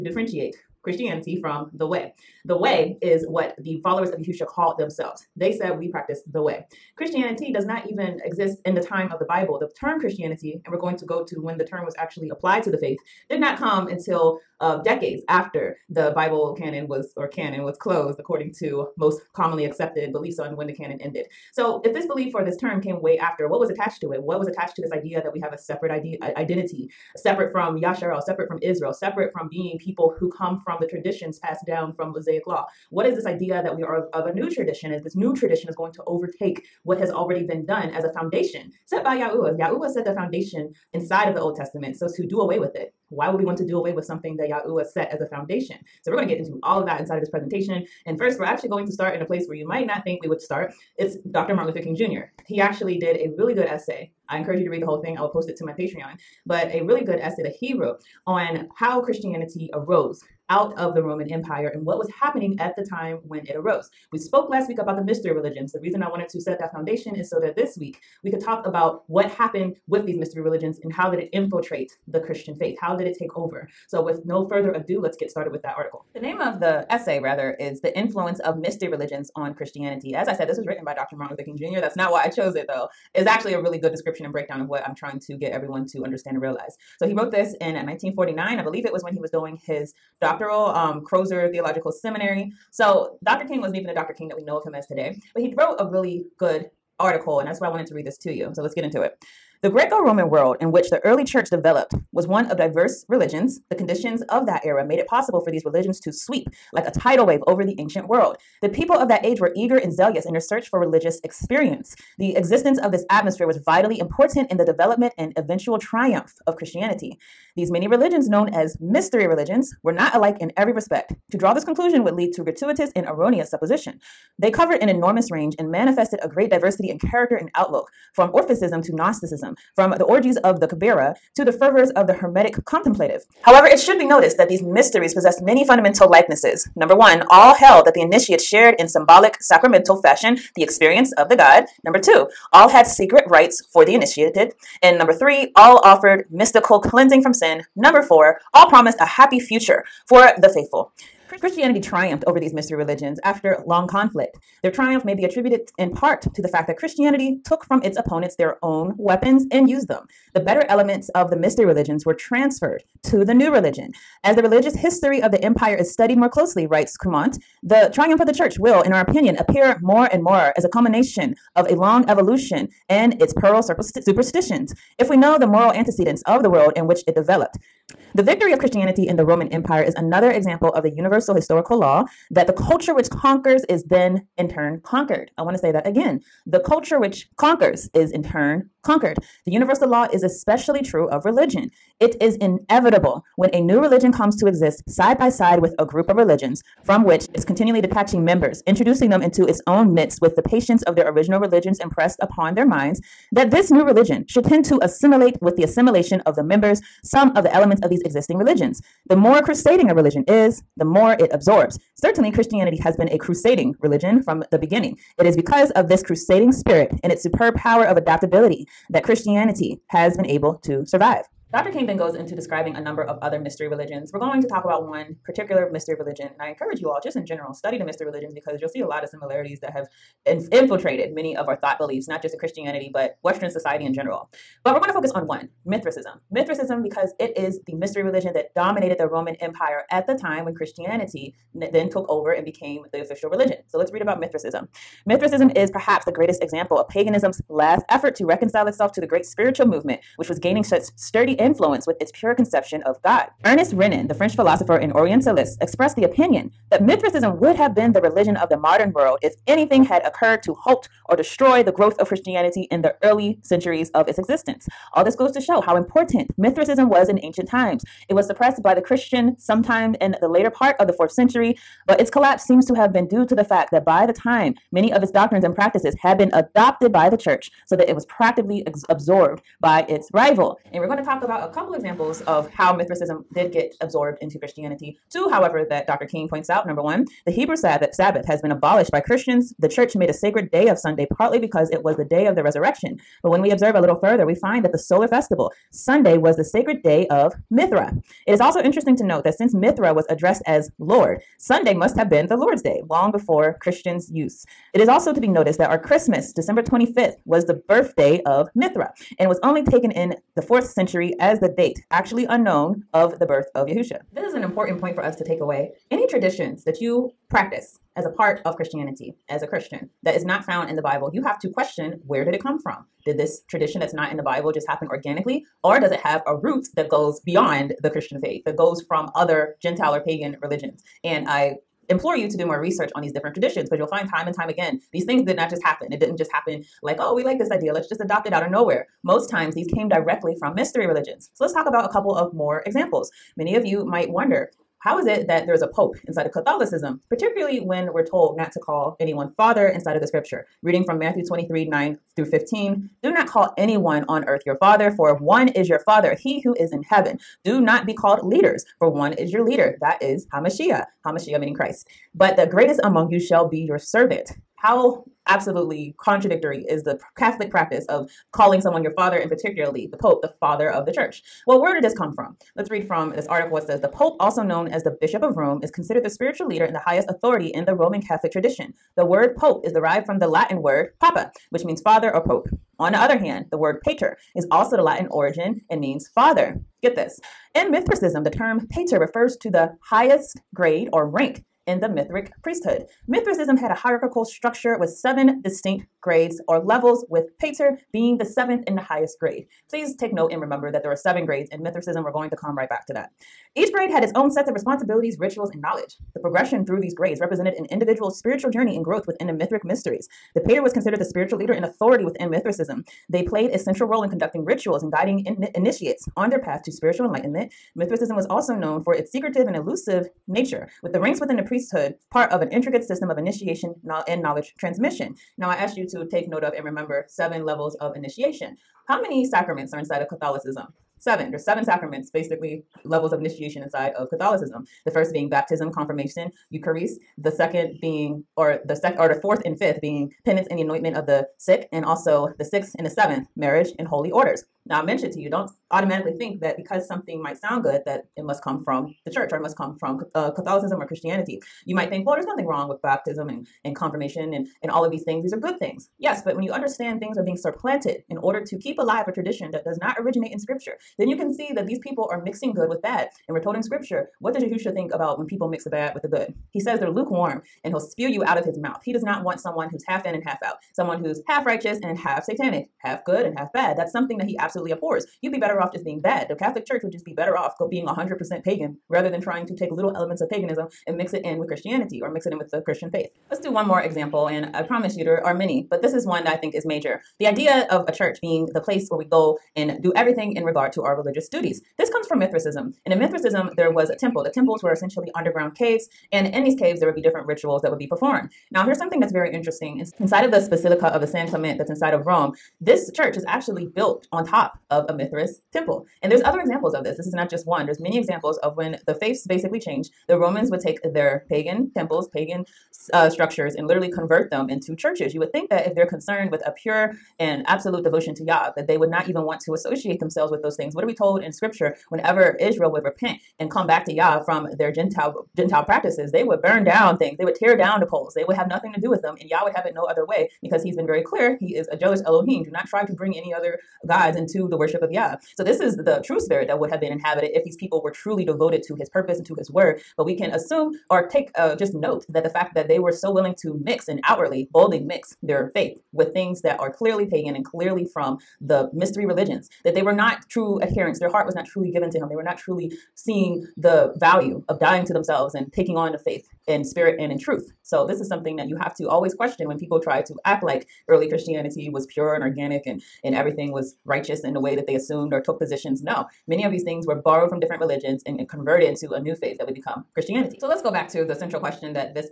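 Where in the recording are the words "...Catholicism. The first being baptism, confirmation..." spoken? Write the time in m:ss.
7:14.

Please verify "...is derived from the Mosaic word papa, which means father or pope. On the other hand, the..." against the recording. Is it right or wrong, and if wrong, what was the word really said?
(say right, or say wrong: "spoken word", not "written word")
wrong: "Latin", not "Mosaic".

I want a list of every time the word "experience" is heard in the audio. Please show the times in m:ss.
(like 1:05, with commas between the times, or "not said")
1:51, 2:20.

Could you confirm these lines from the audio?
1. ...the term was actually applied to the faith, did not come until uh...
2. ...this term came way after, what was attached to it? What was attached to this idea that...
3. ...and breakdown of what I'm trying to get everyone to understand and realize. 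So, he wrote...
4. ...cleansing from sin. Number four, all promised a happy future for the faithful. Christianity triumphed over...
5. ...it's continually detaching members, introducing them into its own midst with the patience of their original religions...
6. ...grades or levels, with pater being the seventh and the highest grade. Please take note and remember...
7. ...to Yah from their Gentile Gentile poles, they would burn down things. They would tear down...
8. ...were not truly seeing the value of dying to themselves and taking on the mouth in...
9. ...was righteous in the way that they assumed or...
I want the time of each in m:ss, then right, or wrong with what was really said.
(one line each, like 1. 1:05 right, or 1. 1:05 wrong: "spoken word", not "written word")
1. 0:11 right
2. 0:22 right
3. 1:24 right
4. 2:26 right
5. 3:17 right
6. 6:36 right
7. 8:43 wrong: "practices", not "poles"
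8. 9:12 wrong: "faith", not "mouth"
9. 9:23 right.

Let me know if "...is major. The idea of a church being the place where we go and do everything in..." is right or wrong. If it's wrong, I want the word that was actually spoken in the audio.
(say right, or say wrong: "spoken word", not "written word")
right.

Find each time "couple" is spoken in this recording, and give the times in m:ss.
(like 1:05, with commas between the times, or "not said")
4:41, 5:41.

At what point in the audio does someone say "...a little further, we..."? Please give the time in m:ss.
4:53.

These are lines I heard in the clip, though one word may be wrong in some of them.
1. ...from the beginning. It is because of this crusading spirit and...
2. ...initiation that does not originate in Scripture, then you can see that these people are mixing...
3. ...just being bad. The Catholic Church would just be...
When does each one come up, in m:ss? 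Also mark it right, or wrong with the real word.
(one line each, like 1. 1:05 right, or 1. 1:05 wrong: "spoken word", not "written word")
1. 3:34 right
2. 7:39 wrong: "tradition", not "initiation"
3. 7:55 right.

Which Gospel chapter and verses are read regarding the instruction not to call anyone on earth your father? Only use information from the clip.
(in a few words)
Matthew 23:9-15.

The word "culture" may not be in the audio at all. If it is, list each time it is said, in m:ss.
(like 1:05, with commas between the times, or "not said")
3:02, 3:06.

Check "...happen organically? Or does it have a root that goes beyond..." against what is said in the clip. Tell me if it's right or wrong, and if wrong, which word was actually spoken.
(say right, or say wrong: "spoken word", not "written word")
right.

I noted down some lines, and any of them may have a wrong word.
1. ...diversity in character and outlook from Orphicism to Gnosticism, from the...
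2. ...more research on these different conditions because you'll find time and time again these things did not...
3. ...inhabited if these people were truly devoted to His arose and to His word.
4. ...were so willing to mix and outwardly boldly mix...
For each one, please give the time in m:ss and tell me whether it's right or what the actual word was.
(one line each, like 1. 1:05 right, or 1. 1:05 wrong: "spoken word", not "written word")
1. 2:06 right
2. 5:32 wrong: "traditions", not "conditions"
3. 8:56 wrong: "purpose", not "arose"
4. 9:02 right.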